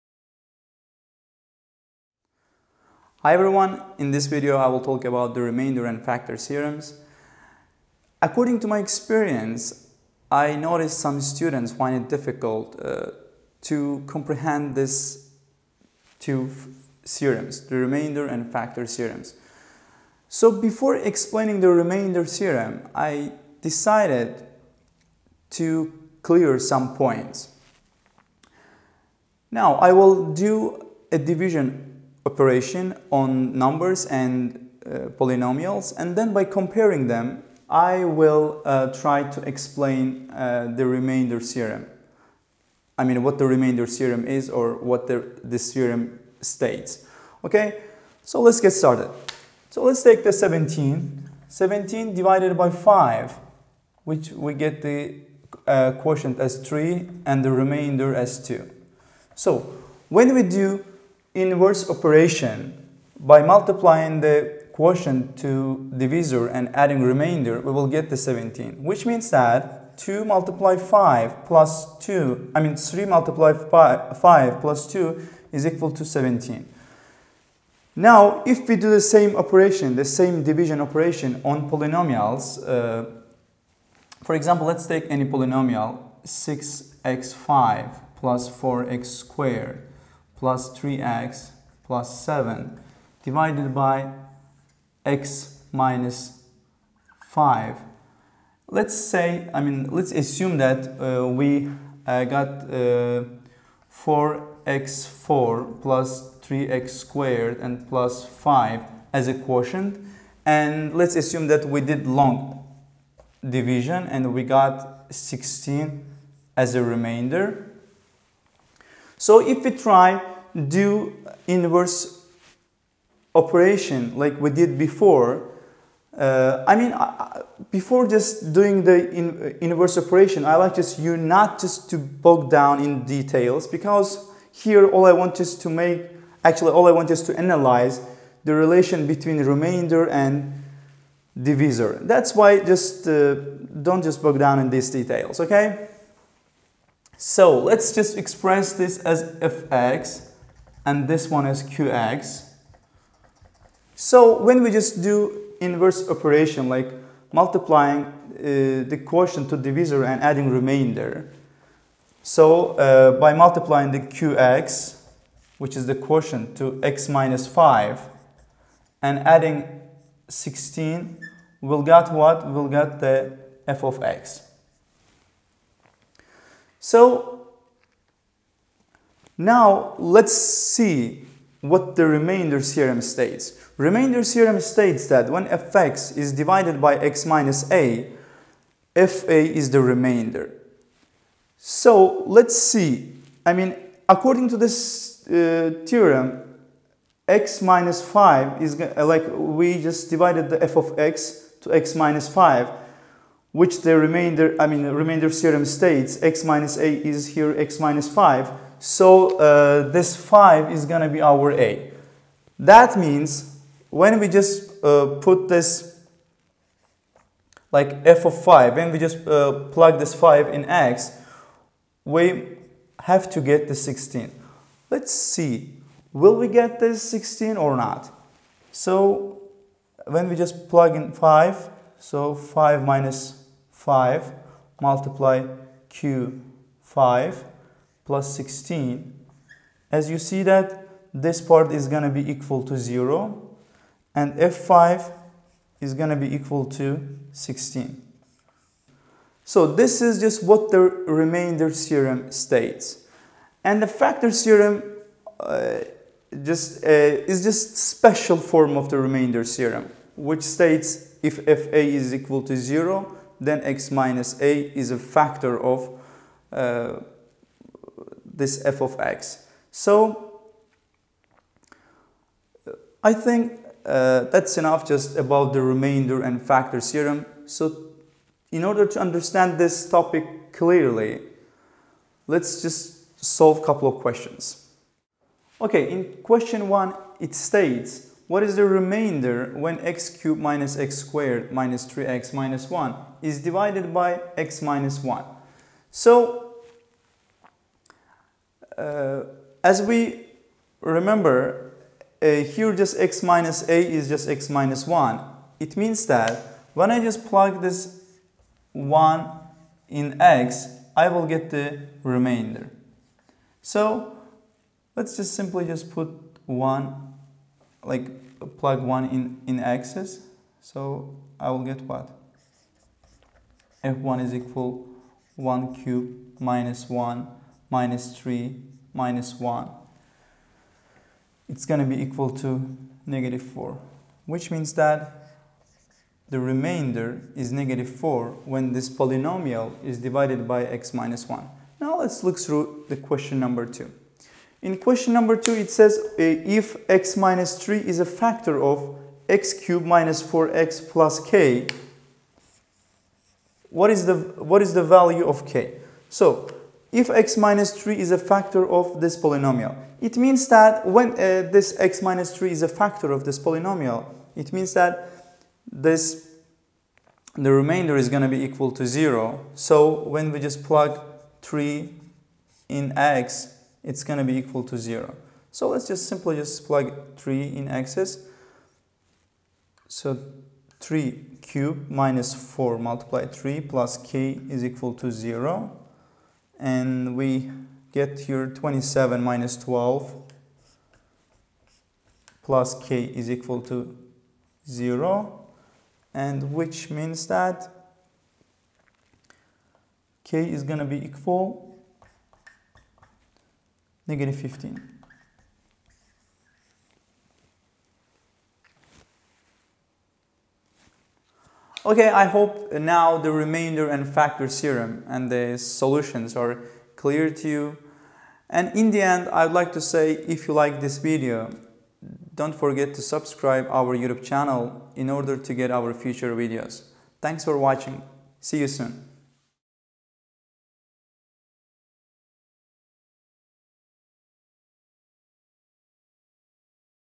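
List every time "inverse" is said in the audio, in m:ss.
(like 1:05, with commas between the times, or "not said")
1:01, 2:01, 2:09, 2:35.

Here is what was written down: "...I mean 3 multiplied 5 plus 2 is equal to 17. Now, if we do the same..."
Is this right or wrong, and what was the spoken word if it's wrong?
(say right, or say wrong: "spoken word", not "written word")
right.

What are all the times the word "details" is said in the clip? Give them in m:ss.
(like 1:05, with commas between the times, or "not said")
2:13, 2:24.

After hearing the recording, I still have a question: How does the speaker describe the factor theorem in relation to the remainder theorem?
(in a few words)
special form.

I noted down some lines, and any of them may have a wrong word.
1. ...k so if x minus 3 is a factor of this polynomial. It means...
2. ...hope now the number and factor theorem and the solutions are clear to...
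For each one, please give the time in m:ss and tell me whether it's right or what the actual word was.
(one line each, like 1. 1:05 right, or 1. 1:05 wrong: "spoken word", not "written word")
1. 5:55 right
2. 6:52 wrong: "remainder", not "number".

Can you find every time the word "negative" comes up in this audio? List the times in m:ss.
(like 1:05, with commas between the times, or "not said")
5:33, 5:37, 6:44.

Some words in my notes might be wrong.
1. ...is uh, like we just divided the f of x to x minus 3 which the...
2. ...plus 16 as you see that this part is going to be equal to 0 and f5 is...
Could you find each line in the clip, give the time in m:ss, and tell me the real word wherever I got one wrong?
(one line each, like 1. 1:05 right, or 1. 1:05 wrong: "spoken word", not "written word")
1. 3:18 wrong: "5", not "3"
2. 3:58 right.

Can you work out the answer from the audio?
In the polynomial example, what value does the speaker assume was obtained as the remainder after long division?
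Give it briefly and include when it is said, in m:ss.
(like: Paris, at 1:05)
16, at 1:55.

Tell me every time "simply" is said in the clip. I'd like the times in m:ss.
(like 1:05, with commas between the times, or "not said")
5:15, 6:16.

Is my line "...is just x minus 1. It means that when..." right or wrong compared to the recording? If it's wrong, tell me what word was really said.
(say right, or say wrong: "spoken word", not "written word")
right.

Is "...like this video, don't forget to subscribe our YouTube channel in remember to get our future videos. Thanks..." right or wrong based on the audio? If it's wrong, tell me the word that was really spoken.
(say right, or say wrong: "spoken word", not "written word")
wrong: "order", not "remember".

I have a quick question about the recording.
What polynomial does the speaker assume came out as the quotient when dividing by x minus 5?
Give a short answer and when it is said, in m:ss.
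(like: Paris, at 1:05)
4x4 plus 3x squared plus 5, at 1:43.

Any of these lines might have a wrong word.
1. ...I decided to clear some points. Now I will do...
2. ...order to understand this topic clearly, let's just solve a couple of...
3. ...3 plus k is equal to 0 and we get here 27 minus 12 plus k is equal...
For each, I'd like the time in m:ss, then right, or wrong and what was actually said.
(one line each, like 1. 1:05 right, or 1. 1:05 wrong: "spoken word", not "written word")
1. 0:22 right
2. 4:38 right
3. 6:23 right.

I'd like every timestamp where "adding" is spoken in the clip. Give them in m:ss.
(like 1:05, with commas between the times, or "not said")
1:06, 2:40, 2:49.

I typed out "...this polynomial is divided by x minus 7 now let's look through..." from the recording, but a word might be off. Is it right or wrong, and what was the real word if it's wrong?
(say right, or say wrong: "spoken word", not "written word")
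wrong: "1", not "7".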